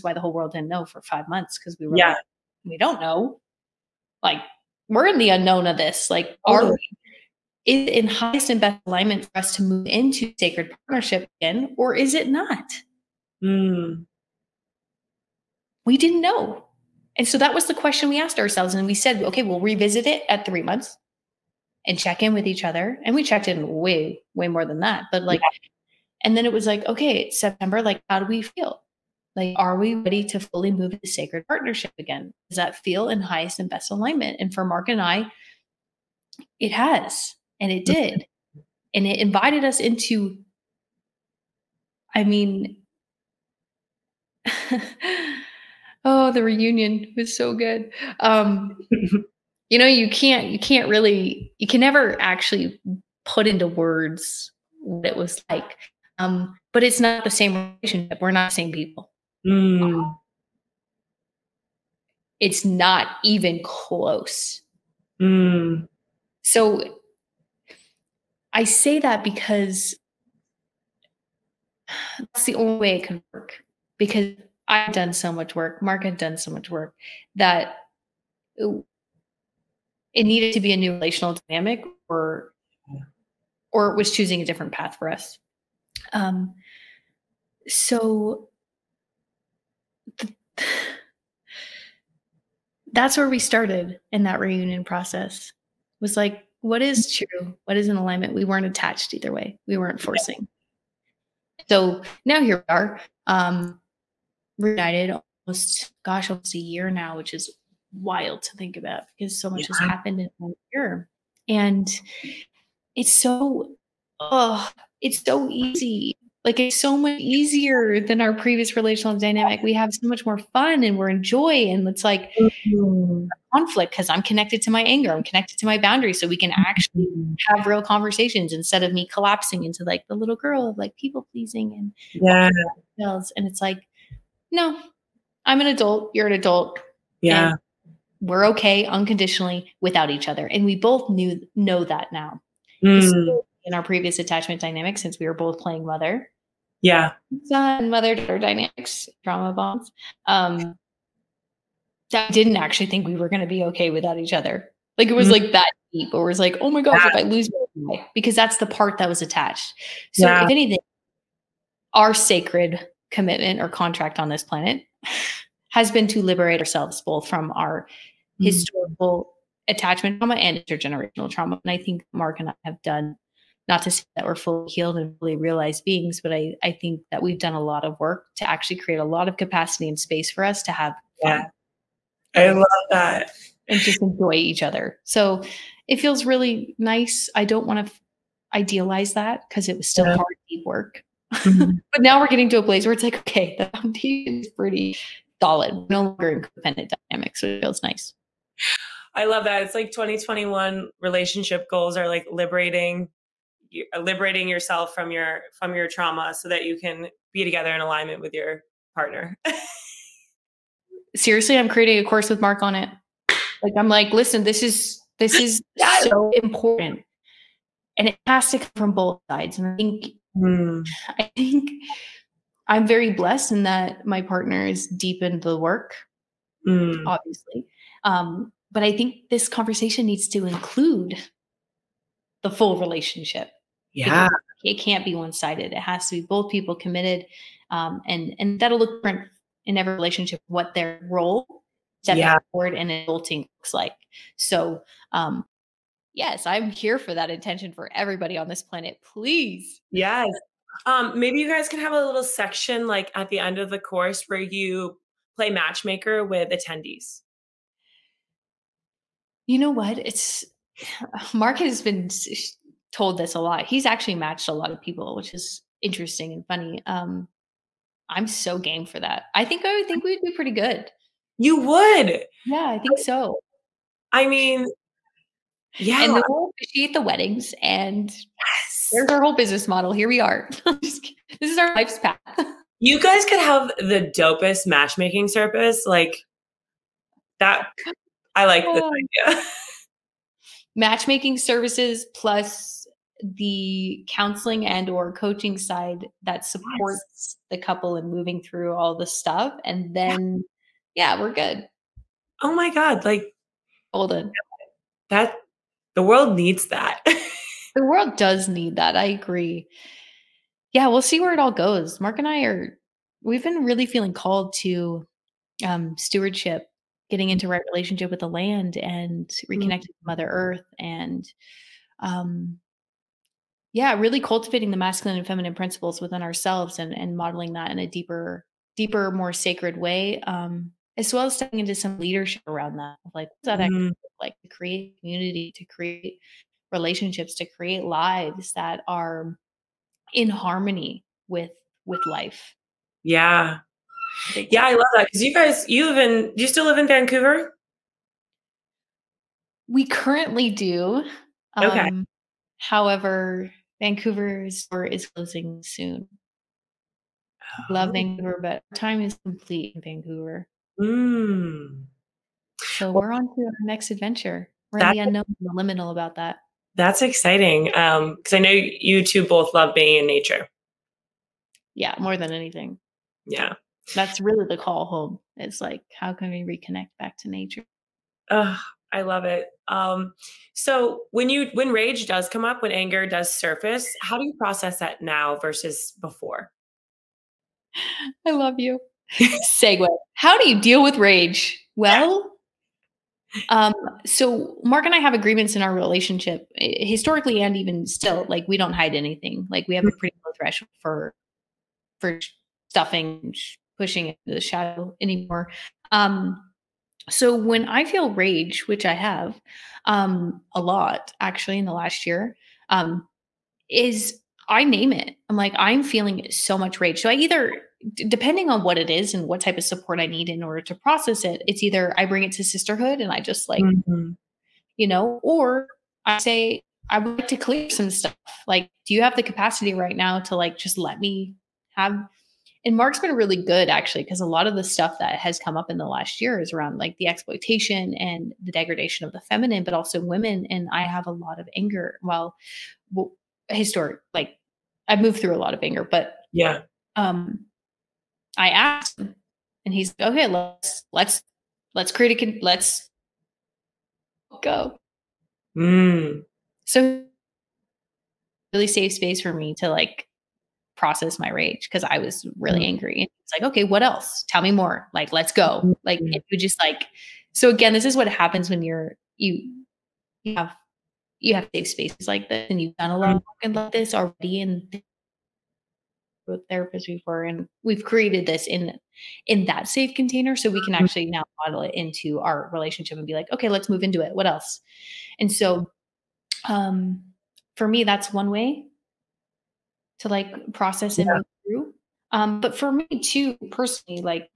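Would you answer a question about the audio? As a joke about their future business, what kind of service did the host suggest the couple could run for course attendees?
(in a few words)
Matchmaking service.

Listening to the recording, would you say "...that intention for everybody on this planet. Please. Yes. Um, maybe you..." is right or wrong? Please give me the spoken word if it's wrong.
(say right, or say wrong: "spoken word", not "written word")
right.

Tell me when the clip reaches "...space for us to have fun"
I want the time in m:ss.
2:59.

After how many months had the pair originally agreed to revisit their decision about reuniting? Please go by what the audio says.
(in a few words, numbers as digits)
3.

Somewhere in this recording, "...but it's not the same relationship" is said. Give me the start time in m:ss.
0:56.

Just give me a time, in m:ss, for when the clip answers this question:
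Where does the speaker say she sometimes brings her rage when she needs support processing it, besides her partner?
7:02.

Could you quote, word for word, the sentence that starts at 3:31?
Seriously, I'm creating a course with Mark on it.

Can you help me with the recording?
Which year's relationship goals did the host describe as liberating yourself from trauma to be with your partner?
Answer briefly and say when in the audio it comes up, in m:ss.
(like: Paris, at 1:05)
2021, at 3:19.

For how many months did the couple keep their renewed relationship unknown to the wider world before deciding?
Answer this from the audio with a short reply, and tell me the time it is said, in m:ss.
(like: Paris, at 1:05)
5, at 0:01.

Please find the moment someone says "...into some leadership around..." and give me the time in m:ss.
5:31.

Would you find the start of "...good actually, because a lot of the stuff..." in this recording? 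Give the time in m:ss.
7:13.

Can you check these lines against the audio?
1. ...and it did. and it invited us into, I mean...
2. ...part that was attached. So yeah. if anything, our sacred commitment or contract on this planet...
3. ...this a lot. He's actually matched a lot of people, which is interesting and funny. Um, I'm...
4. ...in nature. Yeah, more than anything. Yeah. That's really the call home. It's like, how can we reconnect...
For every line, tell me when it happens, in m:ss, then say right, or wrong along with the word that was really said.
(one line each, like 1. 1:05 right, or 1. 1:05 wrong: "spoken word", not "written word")
1. 0:37 right
2. 2:38 right
3. 4:23 right
4. 6:09 right.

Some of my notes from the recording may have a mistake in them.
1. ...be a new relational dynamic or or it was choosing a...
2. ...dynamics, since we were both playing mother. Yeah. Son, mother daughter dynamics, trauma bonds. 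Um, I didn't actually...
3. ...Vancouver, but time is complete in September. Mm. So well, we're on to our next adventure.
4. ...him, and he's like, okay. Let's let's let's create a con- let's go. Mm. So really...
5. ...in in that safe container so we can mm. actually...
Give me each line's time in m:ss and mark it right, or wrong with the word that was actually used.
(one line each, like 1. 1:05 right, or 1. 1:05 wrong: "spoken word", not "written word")
1. 1:20 right
2. 2:24 right
3. 5:57 wrong: "Vancouver", not "September"
4. 7:28 right
5. 7:58 right.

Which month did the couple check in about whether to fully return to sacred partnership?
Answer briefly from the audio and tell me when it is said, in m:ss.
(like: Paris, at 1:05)
September, at 0:27.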